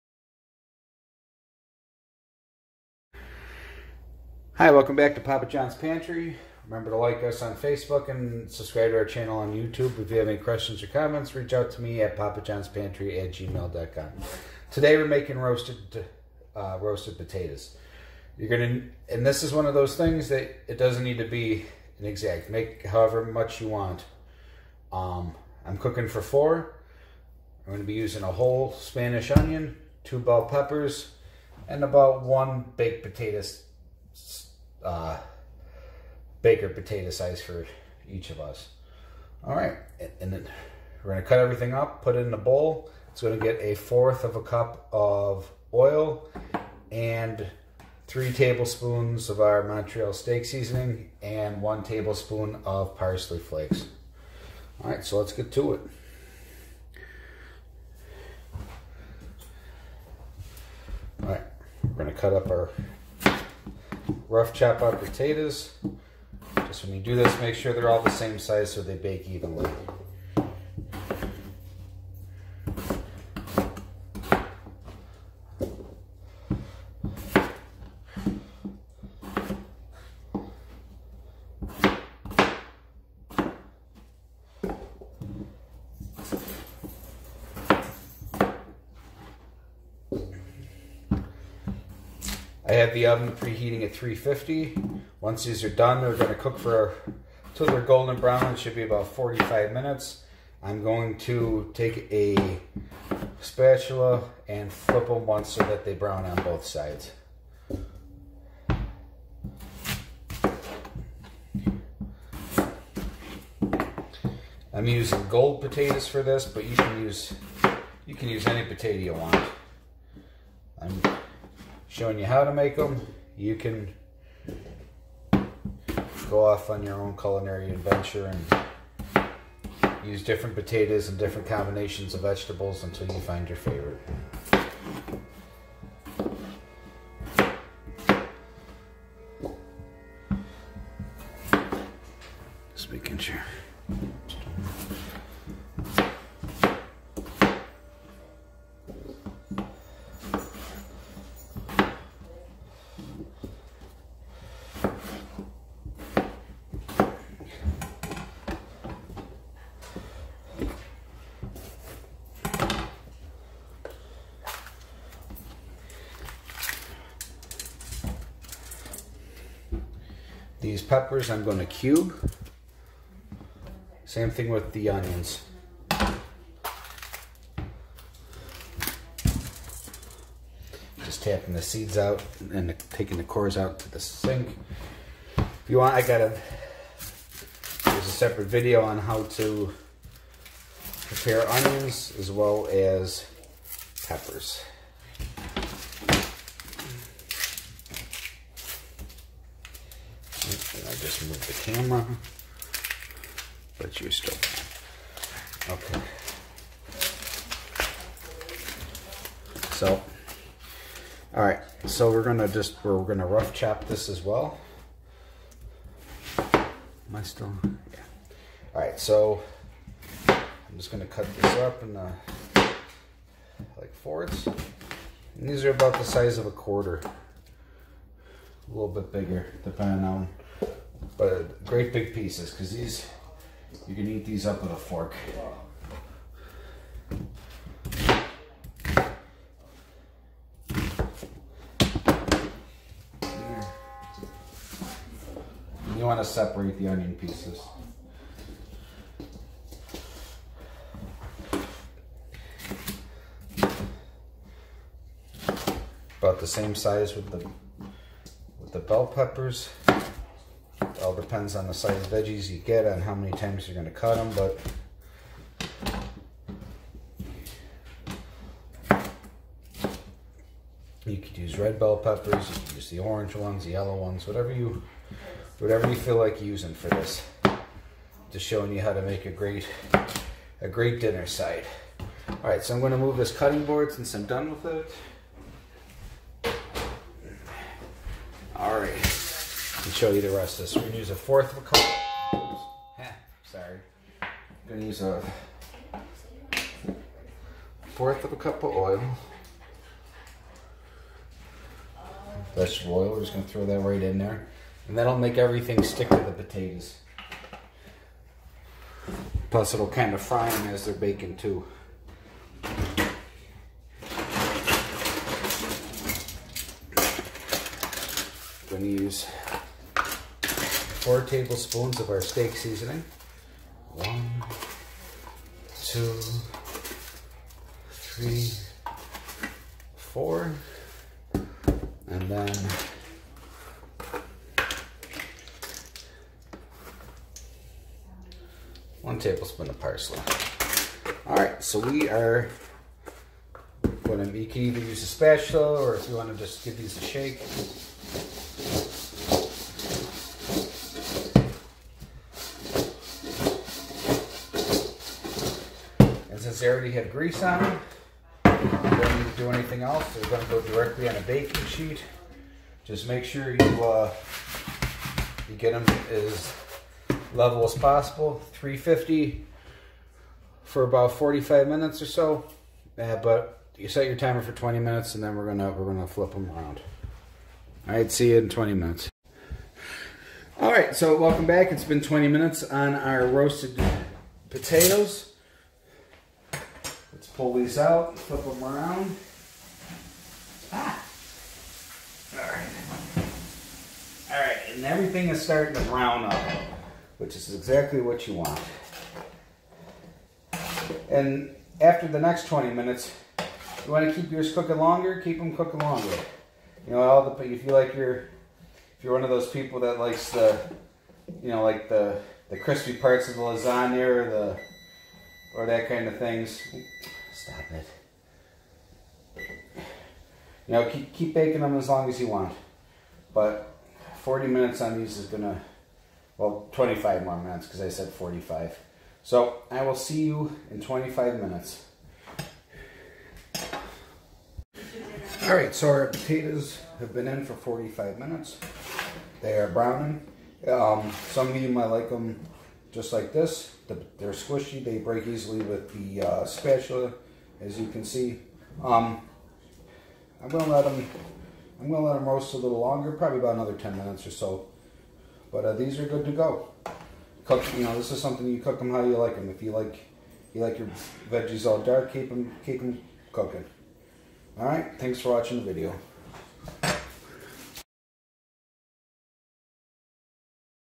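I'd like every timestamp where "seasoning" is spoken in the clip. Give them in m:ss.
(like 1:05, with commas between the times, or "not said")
0:50, 5:22.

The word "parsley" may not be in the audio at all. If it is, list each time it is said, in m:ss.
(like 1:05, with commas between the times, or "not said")
0:52, 5:39.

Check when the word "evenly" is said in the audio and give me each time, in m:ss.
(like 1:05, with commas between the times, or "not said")
1:09.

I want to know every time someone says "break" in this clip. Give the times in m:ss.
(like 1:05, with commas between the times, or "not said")
7:24.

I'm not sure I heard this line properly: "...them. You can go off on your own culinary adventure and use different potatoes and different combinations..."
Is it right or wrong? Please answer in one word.
right.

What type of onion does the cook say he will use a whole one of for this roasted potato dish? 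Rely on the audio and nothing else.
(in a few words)
Spanish onion.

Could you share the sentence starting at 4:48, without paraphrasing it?
All right show you the rest of this.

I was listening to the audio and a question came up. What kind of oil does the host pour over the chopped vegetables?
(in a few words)
Vegetable oil.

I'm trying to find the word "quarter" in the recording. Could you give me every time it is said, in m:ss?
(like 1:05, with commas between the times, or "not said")
3:46.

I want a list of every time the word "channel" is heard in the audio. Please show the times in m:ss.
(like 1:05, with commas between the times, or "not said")
0:09.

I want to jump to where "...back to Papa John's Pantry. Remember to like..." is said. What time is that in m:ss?
0:04.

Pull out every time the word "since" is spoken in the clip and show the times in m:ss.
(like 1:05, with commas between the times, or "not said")
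4:43, 5:56.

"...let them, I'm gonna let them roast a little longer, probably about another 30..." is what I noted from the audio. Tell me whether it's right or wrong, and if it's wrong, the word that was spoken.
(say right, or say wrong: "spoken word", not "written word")
wrong: "10", not "30".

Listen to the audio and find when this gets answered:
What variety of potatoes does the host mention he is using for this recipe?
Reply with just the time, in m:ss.
1:55.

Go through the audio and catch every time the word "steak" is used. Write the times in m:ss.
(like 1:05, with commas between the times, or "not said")
0:50, 5:22.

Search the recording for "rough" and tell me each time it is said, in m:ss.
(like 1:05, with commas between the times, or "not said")
1:04, 3:33.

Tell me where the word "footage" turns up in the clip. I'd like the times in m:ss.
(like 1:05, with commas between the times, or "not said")
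not said.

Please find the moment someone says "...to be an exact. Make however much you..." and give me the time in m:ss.
0:21.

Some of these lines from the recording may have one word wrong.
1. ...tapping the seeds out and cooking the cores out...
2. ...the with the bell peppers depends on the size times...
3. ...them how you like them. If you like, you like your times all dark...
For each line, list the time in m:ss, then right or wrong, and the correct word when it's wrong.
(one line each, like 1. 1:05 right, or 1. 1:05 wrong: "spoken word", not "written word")
1. 3:01 wrong: "taking", not "cooking"
2. 4:17 wrong: "veggies", not "times"
3. 7:38 wrong: "veggies", not "times".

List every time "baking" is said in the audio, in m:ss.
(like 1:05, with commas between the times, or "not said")
5:10, 6:01, 7:01.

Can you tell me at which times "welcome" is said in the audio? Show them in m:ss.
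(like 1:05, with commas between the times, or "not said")
0:04, 6:21.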